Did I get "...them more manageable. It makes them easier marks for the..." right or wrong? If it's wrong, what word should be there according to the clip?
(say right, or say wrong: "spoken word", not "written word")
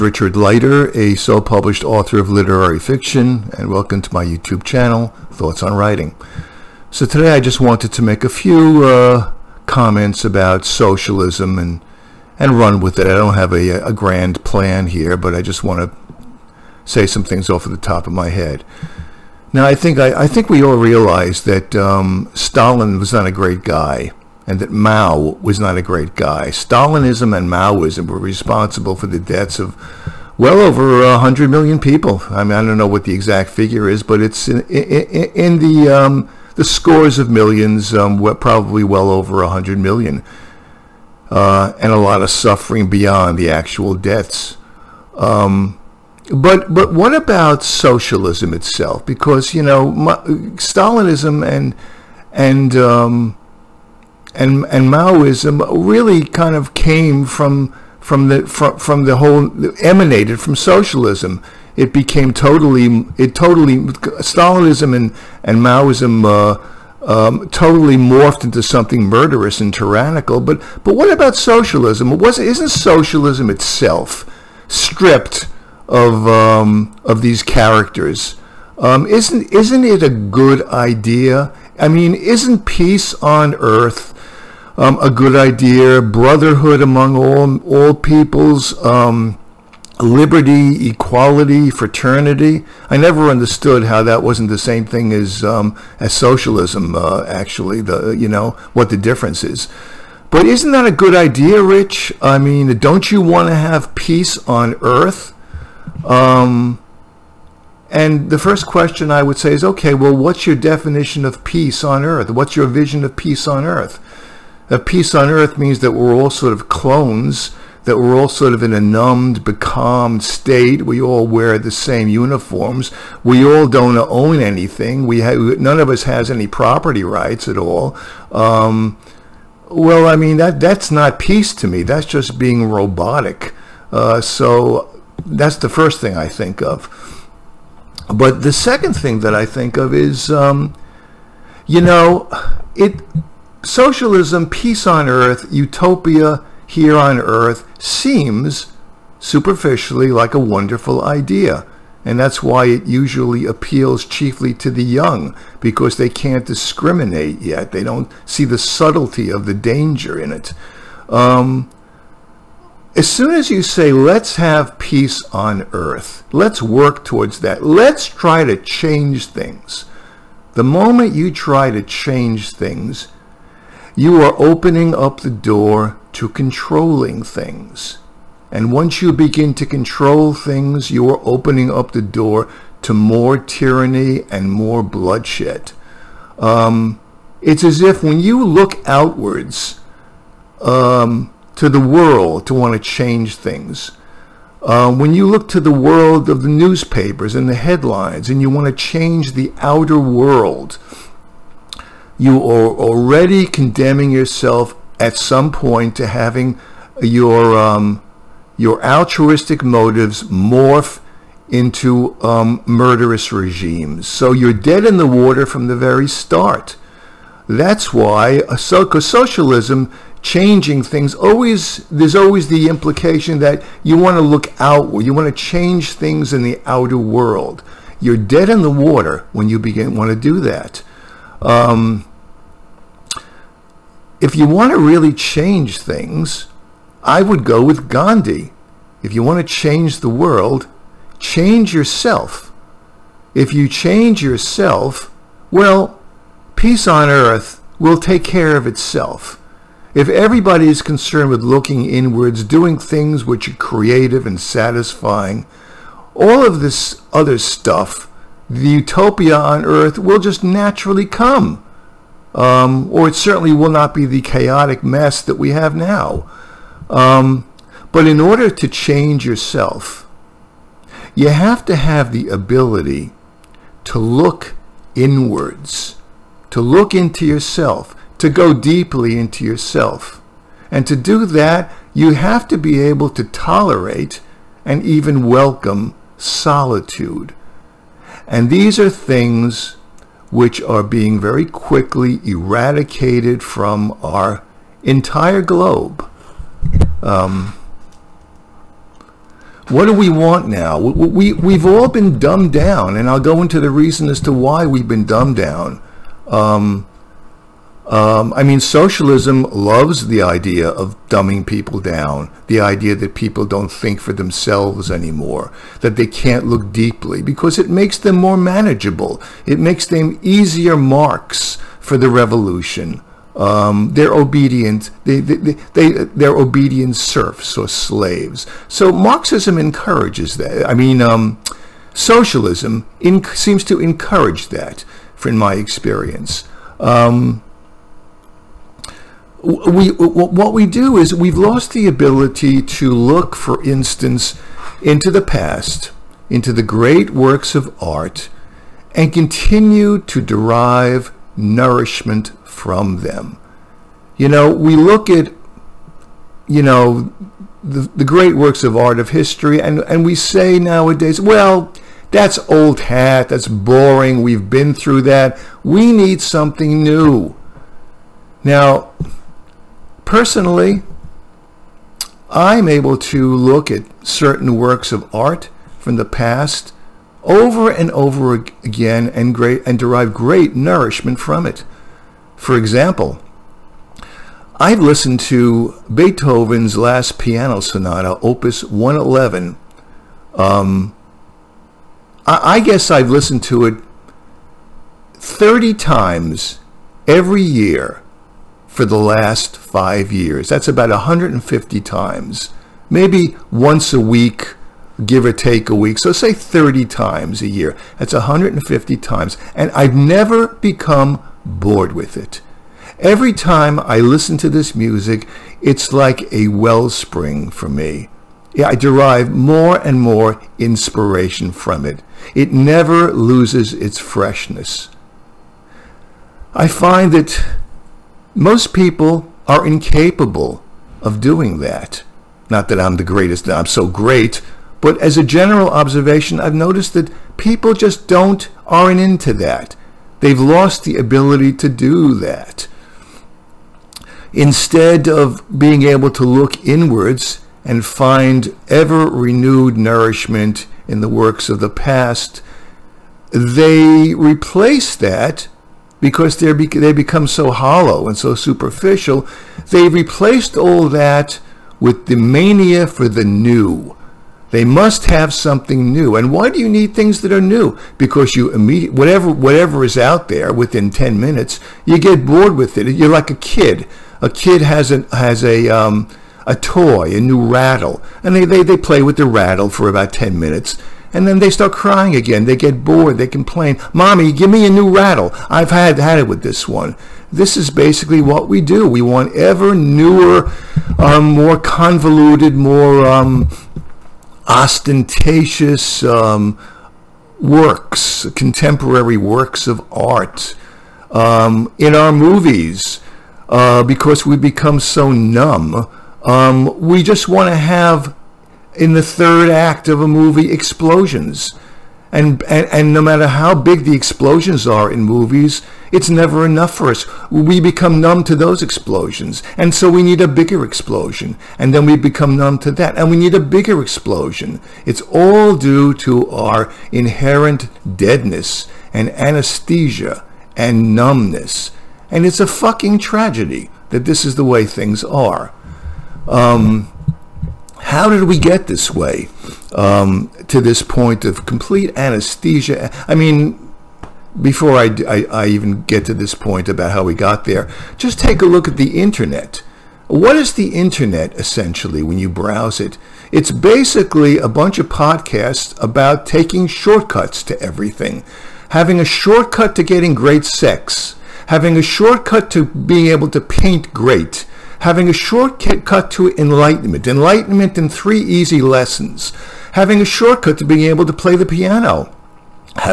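right.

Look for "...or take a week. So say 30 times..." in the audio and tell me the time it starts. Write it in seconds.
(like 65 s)
405 s.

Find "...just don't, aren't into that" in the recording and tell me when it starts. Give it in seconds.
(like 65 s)
437 s.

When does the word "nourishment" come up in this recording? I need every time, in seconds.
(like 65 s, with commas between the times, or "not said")
351 s, 380 s, 449 s.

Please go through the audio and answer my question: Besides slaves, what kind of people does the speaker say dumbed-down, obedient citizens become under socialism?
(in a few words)
serfs.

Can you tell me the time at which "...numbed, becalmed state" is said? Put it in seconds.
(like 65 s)
118 s.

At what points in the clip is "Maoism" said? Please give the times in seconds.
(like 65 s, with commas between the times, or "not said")
27 s, 54 s, 65 s.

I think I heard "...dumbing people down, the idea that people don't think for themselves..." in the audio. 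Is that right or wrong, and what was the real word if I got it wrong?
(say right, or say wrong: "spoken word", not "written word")
right.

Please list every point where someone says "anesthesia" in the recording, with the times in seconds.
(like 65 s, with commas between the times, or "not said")
529 s, 541 s.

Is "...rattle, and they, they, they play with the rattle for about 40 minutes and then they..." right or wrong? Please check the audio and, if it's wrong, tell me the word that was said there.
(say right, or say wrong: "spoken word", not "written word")
wrong: "10", not "40".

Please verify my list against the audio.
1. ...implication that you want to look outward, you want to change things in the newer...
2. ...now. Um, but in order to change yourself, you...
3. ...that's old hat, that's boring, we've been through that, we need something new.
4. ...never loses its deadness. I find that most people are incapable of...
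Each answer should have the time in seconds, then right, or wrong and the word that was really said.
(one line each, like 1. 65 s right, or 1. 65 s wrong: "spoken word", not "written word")
1. 222 s wrong: "outer", not "newer"
2. 265 s right
3. 362 s right
4. 422 s wrong: "freshness", not "deadness".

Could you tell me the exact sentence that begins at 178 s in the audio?
And once you begin to control things, you are opening up the door to more tyranny and more bloodshed.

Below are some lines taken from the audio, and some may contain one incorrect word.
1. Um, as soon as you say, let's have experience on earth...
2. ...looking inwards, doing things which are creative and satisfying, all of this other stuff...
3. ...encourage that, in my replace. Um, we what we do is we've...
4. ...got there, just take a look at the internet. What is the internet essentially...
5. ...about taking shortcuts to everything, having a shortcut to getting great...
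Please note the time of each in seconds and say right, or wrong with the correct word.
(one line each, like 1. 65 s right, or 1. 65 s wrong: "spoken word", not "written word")
1. 161 s wrong: "peace", not "experience"
2. 251 s right
3. 333 s wrong: "experience", not "replace"
4. 547 s right
5. 555 s right.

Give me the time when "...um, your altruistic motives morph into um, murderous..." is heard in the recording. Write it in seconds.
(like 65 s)
207 s.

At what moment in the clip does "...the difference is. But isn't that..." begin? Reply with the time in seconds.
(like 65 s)
98 s.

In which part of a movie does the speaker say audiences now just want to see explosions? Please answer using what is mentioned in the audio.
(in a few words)
the third act.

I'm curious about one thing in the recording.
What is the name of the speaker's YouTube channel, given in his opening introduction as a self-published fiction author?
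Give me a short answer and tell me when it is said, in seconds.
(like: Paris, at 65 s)
Thoughts on Writing, at 5 s.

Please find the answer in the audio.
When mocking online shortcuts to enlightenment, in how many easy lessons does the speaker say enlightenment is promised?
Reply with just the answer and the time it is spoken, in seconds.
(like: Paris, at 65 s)
3, at 567 s.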